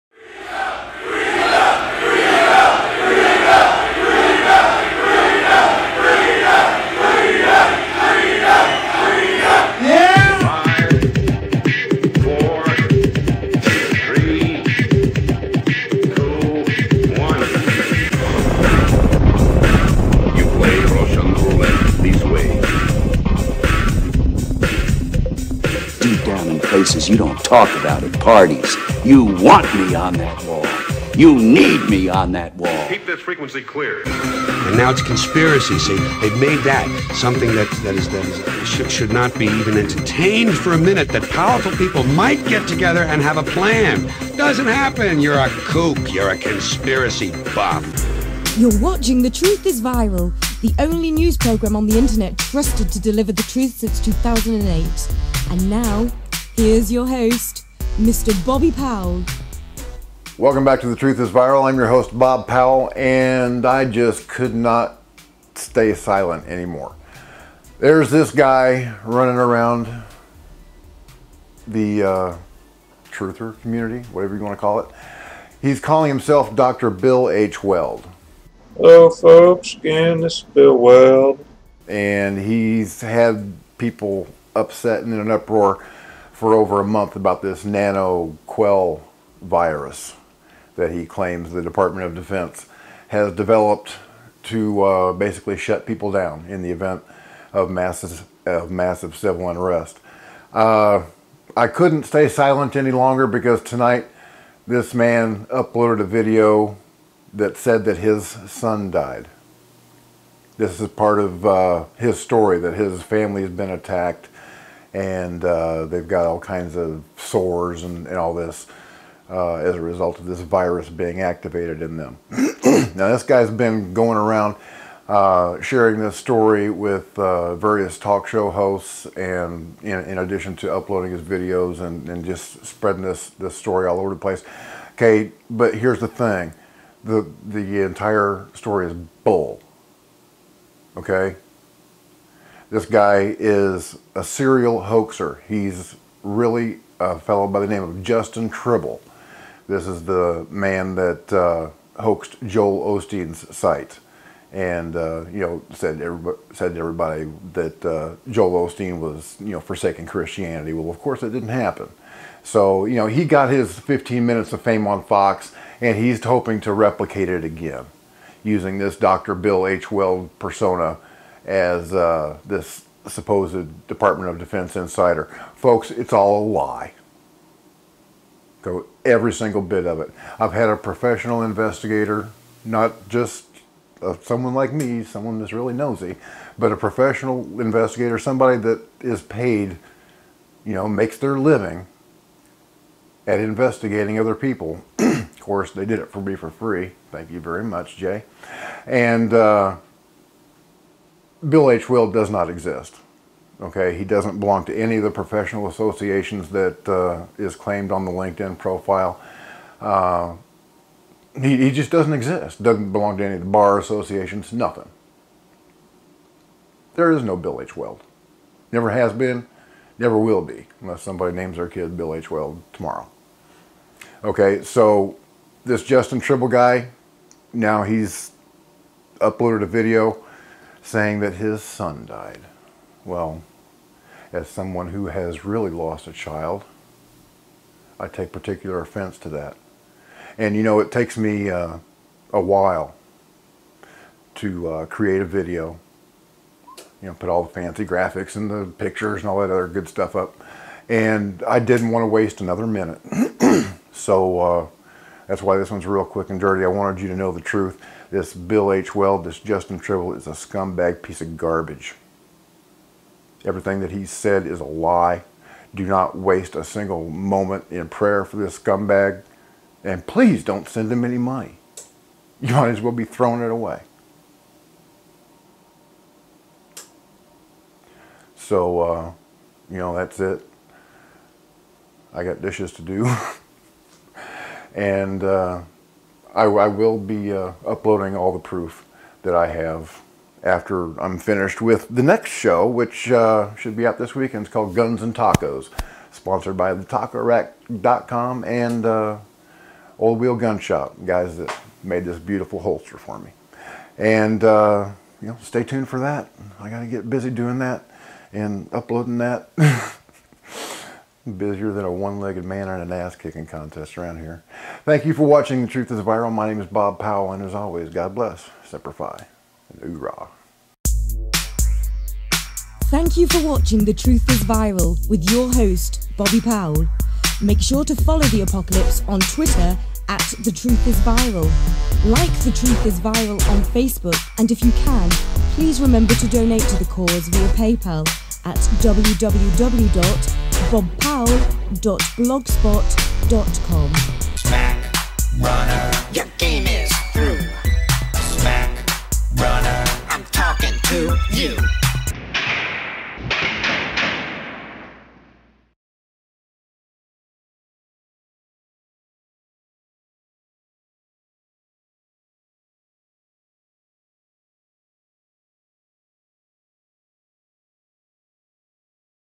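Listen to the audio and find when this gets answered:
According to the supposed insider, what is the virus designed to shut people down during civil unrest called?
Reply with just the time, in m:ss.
1:27.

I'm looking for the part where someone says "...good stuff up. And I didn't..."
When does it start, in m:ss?
4:09.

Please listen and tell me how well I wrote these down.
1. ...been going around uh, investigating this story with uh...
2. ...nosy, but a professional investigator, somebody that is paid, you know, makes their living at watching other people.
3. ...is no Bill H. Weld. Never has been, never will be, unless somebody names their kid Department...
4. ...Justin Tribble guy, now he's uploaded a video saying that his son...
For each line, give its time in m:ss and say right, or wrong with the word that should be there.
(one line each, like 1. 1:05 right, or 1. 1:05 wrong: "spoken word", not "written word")
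1. 2:03 wrong: "sharing", not "investigating"
2. 3:05 wrong: "investigating", not "watching"
3. 3:37 wrong: "Bill", not "Department"
4. 3:45 right.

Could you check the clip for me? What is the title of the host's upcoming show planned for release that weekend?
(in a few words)
Guns and Tacos.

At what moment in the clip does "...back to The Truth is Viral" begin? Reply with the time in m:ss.
1:00.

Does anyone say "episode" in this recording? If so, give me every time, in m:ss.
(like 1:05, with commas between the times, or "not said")
not said.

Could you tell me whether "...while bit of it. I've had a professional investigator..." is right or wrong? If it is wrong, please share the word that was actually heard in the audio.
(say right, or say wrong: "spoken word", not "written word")
wrong: "single", not "while".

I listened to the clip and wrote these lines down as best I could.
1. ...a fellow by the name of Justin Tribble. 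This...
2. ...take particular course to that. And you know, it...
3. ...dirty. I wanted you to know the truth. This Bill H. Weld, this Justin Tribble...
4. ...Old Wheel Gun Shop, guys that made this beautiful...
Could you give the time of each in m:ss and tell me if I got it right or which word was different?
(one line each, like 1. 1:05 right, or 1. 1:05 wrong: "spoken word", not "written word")
1. 2:27 right
2. 3:58 wrong: "offense", not "course"
3. 4:16 right
4. 4:59 right.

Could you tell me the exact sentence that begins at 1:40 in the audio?
Uh, I couldn't stay silent any longer because tonight this man uploaded a video that said that his son died.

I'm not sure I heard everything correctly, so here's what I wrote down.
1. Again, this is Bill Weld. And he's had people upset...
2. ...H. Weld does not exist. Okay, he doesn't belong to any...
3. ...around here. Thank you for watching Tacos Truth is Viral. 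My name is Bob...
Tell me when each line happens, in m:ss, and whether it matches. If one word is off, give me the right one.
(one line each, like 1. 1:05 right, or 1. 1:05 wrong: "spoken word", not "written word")
1. 1:19 right
2. 3:21 right
3. 5:13 wrong: "The", not "Tacos".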